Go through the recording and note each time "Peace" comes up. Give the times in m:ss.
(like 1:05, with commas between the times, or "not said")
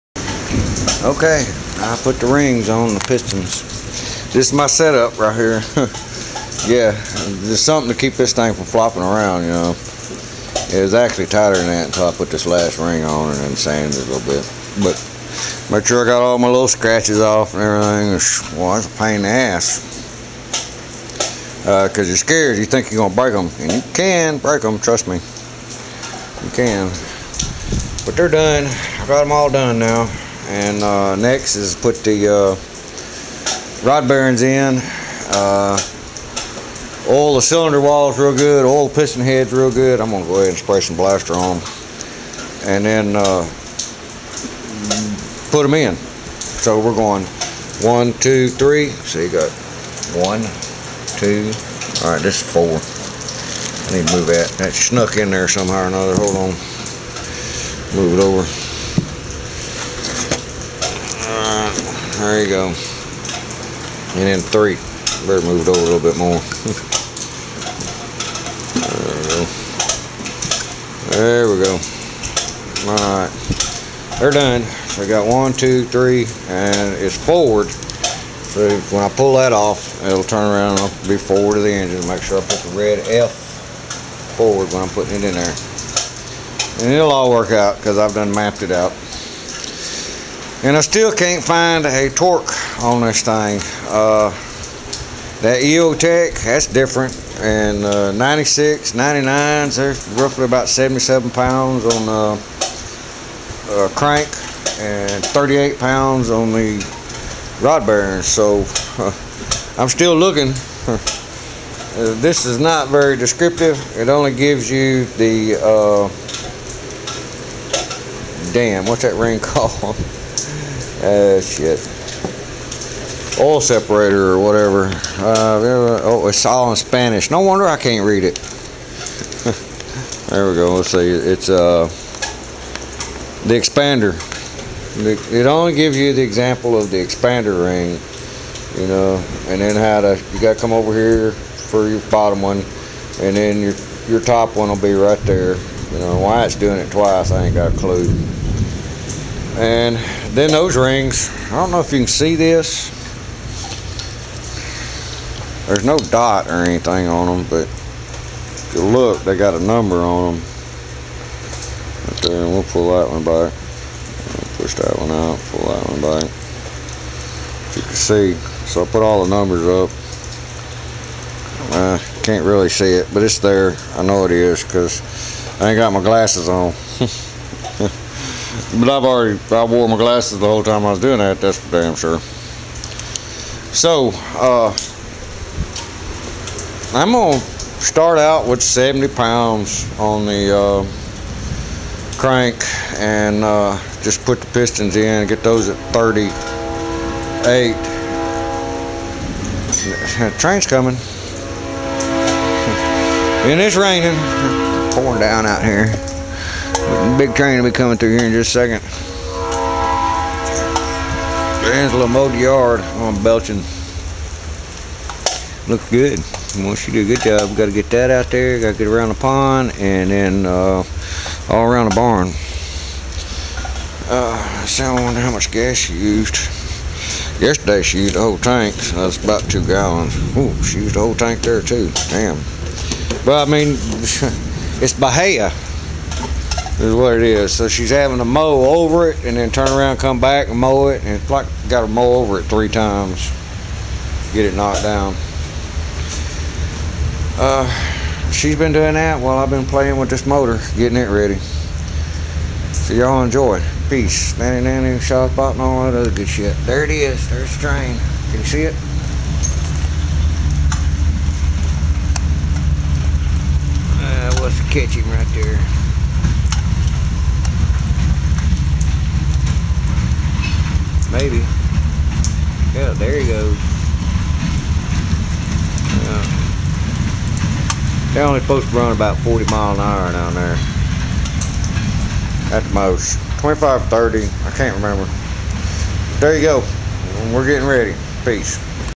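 4:13, 4:48.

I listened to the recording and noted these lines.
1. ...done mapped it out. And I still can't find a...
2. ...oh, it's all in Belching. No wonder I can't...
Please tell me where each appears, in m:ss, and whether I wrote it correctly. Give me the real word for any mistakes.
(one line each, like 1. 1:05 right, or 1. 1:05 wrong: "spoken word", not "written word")
1. 1:28 right
2. 2:06 wrong: "Spanish", not "Belching".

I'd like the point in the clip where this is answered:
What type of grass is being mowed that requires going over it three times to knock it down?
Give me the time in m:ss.
3:54.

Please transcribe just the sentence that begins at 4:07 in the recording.
Uh, she's been doing that while I've been playing with this motor, getting it ready.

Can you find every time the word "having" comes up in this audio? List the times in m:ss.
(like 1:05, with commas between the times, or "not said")
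3:57.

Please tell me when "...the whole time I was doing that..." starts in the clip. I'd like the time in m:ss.
3:00.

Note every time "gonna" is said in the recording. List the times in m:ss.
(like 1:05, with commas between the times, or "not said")
0:40, 3:07.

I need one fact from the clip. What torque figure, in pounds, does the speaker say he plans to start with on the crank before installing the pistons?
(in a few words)
70.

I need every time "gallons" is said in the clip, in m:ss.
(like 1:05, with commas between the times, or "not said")
3:49.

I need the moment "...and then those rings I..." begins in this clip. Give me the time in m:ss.
2:29.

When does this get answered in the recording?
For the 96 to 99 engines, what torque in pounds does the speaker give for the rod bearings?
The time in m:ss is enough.
1:45.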